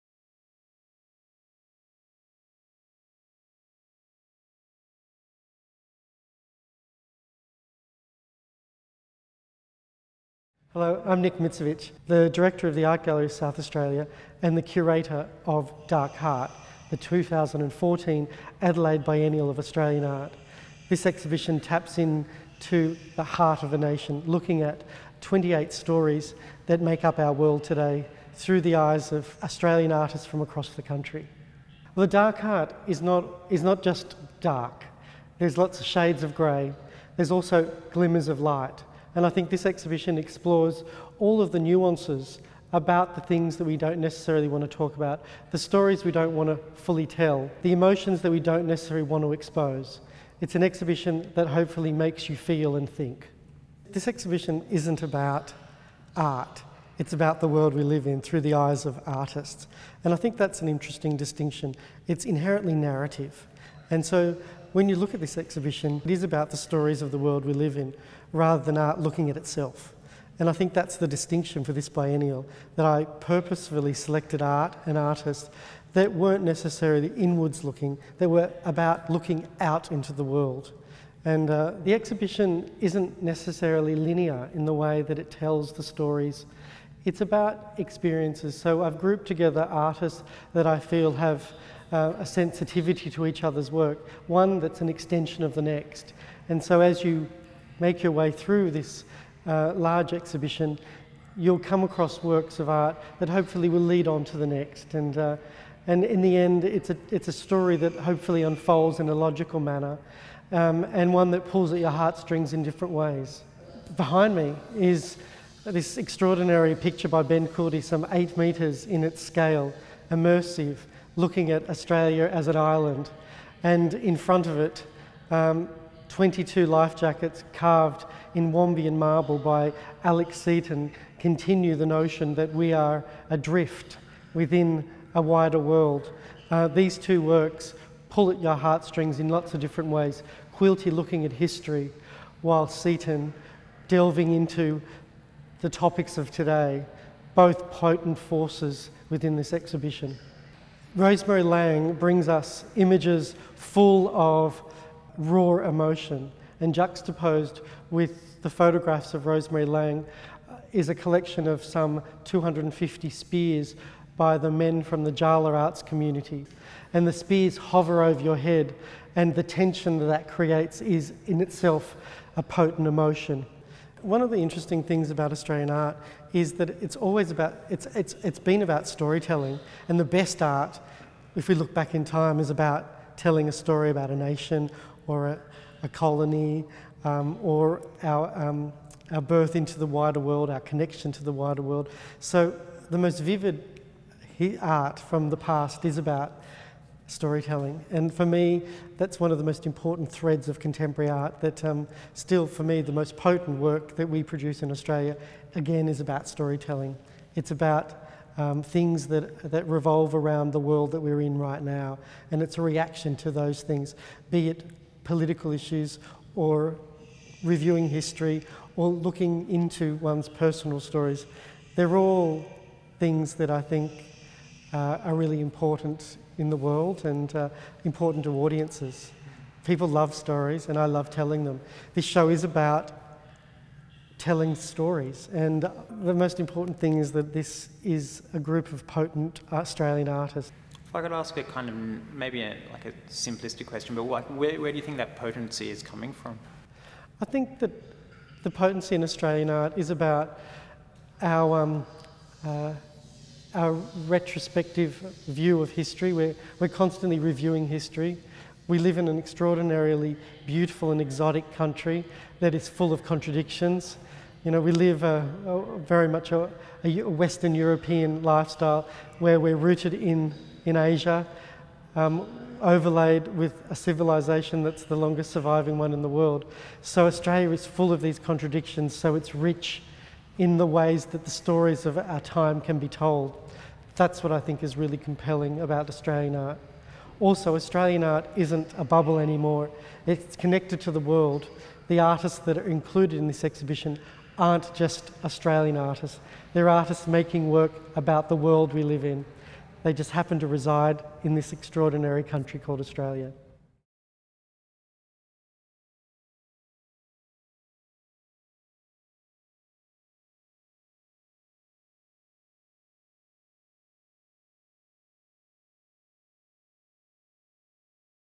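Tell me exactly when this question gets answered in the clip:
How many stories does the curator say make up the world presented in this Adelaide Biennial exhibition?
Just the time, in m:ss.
0:25.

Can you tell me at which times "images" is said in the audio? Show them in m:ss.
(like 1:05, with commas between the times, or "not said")
2:32.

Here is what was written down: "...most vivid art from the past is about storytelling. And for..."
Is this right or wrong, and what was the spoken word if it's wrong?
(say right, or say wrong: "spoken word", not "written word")
right.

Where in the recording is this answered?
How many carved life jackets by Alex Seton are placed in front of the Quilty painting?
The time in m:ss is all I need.
2:06.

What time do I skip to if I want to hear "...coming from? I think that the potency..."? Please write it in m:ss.
4:05.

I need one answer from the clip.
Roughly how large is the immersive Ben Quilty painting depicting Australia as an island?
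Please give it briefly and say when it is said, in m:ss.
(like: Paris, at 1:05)
8 metres, at 1:58.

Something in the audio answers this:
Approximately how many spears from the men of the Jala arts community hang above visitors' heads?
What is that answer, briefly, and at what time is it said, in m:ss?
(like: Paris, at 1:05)
250, at 2:42.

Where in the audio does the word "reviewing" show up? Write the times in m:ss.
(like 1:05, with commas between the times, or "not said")
3:37, 4:17.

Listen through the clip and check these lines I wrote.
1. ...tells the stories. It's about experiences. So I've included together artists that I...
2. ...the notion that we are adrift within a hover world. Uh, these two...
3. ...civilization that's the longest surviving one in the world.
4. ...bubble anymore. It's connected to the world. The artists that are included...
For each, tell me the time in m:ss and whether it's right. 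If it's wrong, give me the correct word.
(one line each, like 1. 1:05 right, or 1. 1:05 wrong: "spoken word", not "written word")
1. 1:25 wrong: "grouped", not "included"
2. 2:11 wrong: "wider", not "hover"
3. 4:33 right
4. 4:48 right.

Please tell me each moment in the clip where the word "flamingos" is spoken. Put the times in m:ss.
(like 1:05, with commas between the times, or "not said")
not said.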